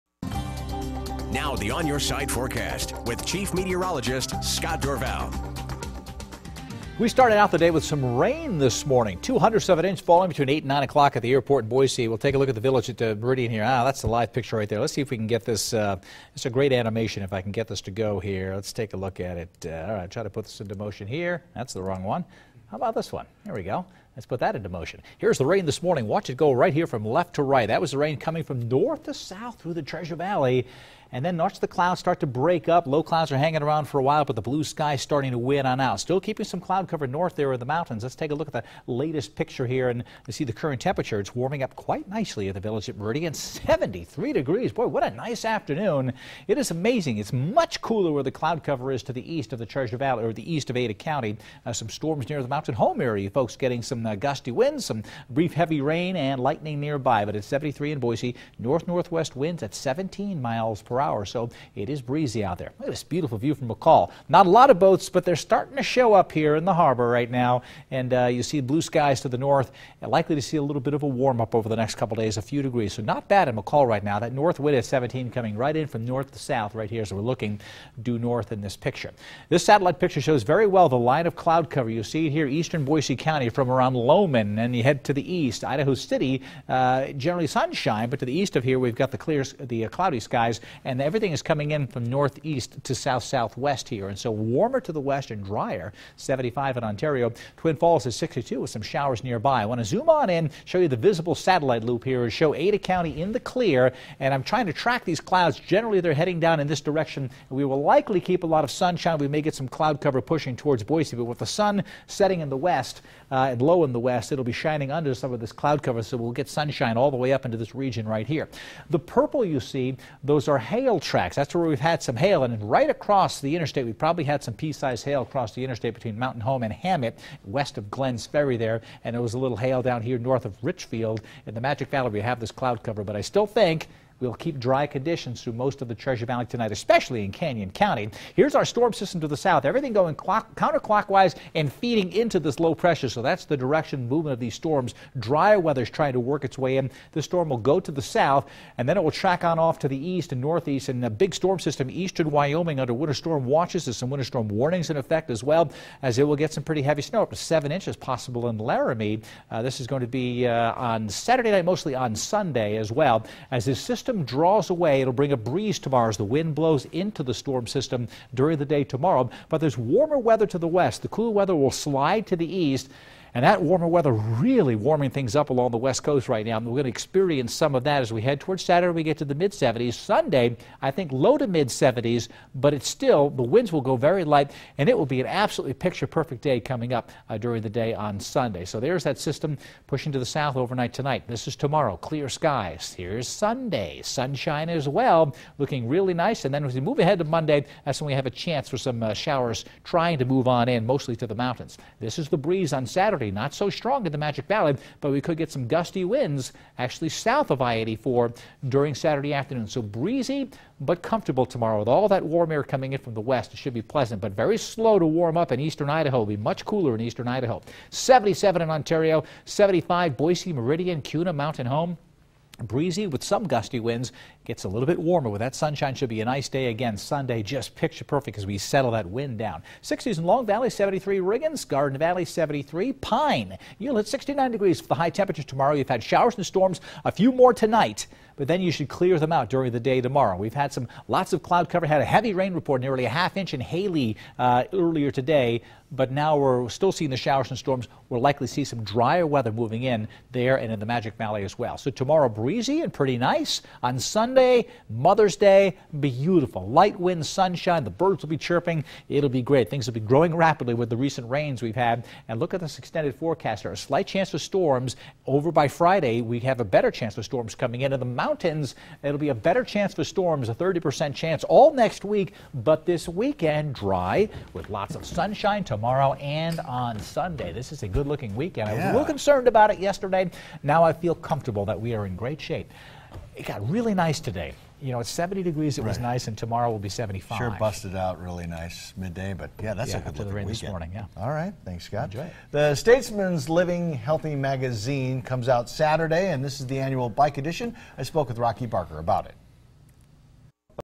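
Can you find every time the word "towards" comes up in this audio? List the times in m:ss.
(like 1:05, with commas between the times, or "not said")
1:50, 2:58.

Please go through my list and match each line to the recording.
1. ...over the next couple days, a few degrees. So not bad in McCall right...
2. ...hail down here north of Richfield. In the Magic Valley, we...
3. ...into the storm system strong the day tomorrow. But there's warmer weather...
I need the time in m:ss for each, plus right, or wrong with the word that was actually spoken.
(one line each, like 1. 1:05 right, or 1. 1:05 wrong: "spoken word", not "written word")
1. 1:11 right
2. 2:09 right
3. 2:46 wrong: "during", not "strong".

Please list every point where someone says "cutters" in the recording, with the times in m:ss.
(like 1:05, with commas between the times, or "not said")
not said.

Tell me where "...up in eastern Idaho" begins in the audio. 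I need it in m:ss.
3:35.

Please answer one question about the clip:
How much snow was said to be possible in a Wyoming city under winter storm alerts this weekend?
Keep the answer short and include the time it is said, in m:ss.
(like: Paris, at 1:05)
7 inches, at 2:37.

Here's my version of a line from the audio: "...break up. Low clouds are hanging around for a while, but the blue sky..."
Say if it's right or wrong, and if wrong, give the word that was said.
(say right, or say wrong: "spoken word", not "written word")
right.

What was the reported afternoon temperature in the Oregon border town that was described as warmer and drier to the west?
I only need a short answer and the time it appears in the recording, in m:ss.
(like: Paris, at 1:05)
75, at 1:36.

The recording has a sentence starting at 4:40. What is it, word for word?
Now I feel comfortable that we are in great shape it got really nice today.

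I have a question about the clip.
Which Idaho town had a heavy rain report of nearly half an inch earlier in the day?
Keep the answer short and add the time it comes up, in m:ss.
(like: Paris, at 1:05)
Hailey, at 4:03.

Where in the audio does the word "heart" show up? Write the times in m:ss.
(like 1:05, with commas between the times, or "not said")
not said.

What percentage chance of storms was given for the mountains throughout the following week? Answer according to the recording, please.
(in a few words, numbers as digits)
30%.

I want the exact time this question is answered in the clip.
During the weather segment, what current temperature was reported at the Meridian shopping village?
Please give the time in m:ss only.
0:43.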